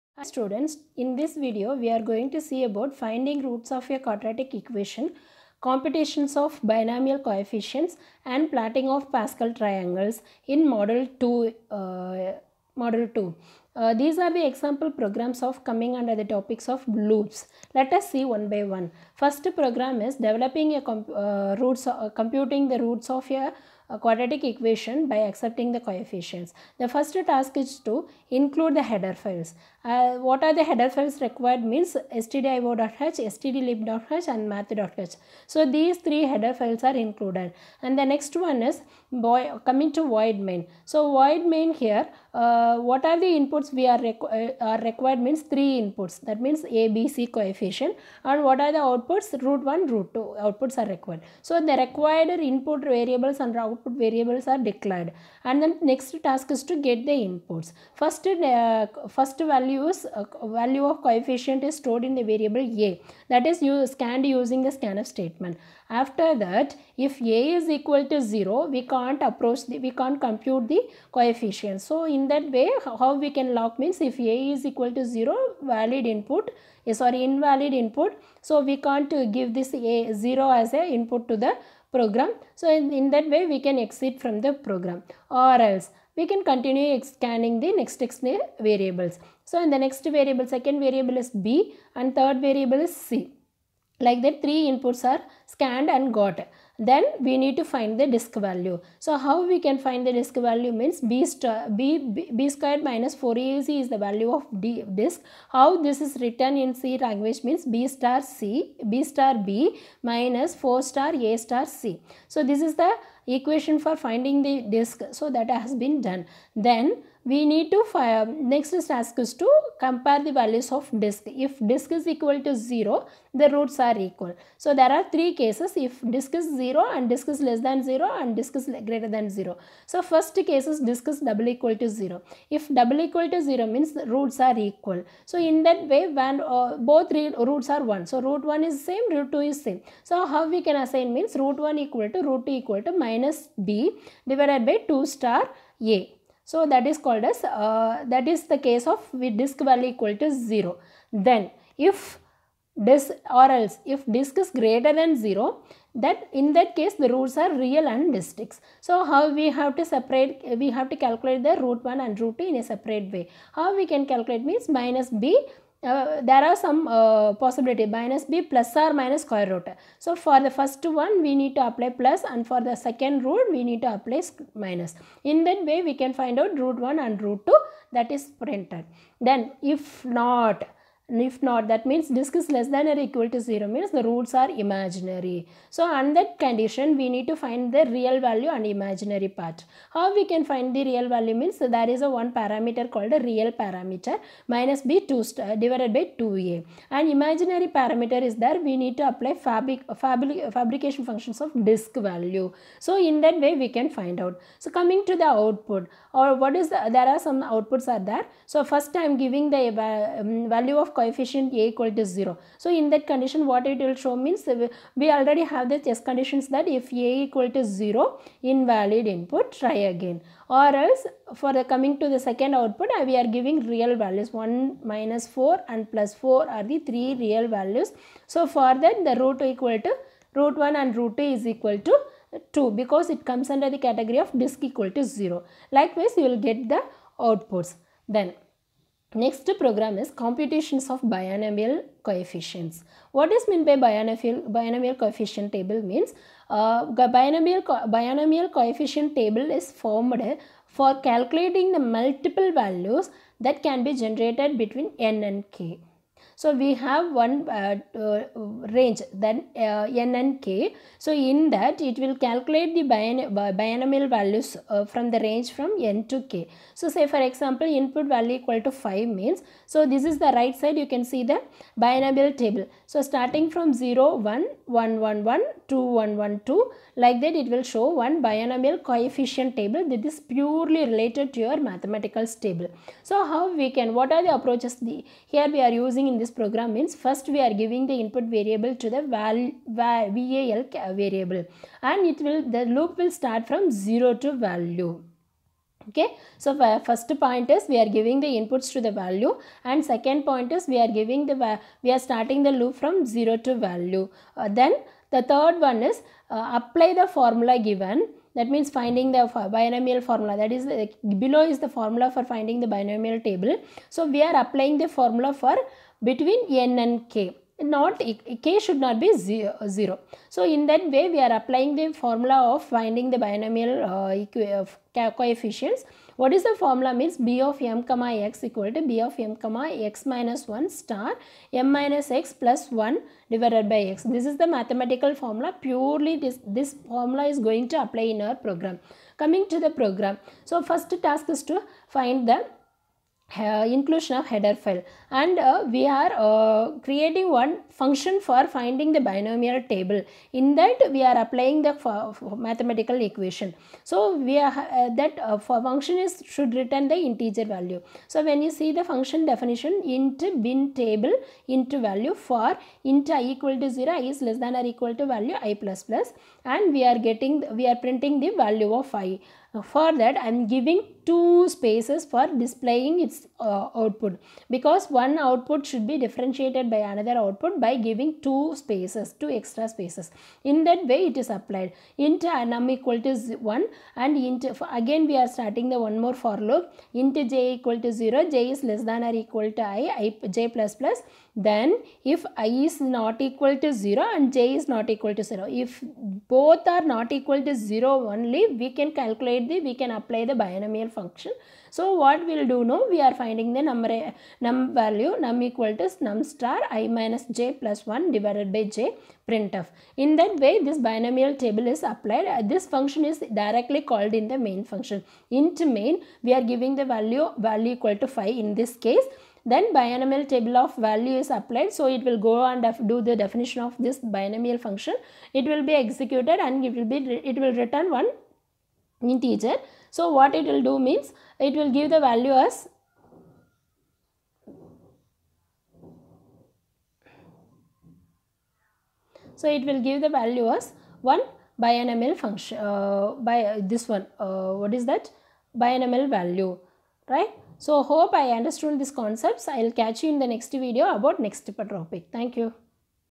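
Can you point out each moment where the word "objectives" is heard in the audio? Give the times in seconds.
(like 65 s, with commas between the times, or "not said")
not said.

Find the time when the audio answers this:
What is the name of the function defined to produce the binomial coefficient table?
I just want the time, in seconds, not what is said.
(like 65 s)
360 s.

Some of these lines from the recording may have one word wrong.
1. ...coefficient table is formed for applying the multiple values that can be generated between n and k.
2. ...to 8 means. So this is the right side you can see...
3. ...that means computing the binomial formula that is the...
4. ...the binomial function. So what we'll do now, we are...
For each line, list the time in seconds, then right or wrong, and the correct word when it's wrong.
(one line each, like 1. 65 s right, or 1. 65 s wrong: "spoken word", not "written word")
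1. 248 s wrong: "calculating", not "applying"
2. 268 s wrong: "5", not "8"
3. 308 s wrong: "finding", not "computing"
4. 400 s right.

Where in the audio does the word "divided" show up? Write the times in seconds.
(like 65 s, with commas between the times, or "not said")
144 s, 195 s, 333 s, 408 s.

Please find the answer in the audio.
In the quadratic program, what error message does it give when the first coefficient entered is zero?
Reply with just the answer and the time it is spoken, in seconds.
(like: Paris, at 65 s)
Invalid input, try again, at 218 s.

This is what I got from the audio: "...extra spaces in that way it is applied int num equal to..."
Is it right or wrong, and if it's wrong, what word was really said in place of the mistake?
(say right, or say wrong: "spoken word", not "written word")
right.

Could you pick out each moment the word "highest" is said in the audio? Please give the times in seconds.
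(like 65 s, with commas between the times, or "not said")
not said.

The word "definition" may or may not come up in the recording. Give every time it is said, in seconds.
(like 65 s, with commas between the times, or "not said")
359 s, 423 s.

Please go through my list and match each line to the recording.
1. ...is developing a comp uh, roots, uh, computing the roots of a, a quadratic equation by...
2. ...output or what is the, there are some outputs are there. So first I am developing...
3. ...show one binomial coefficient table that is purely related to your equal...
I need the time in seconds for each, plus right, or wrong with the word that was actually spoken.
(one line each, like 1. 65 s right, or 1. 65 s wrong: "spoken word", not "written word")
1. 20 s right
2. 205 s wrong: "giving", not "developing"
3. 277 s wrong: "mathematical", not "equal".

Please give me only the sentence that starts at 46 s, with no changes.
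That means A, B, C coefficient.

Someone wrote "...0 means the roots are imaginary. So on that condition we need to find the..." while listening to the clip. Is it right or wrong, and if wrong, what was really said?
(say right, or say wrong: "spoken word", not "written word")
right.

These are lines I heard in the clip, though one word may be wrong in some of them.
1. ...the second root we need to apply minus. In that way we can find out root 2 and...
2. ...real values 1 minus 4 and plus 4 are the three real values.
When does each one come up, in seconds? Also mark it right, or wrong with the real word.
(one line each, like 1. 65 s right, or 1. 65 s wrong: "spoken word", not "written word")
1. 172 s wrong: "1", not "2"
2. 223 s right.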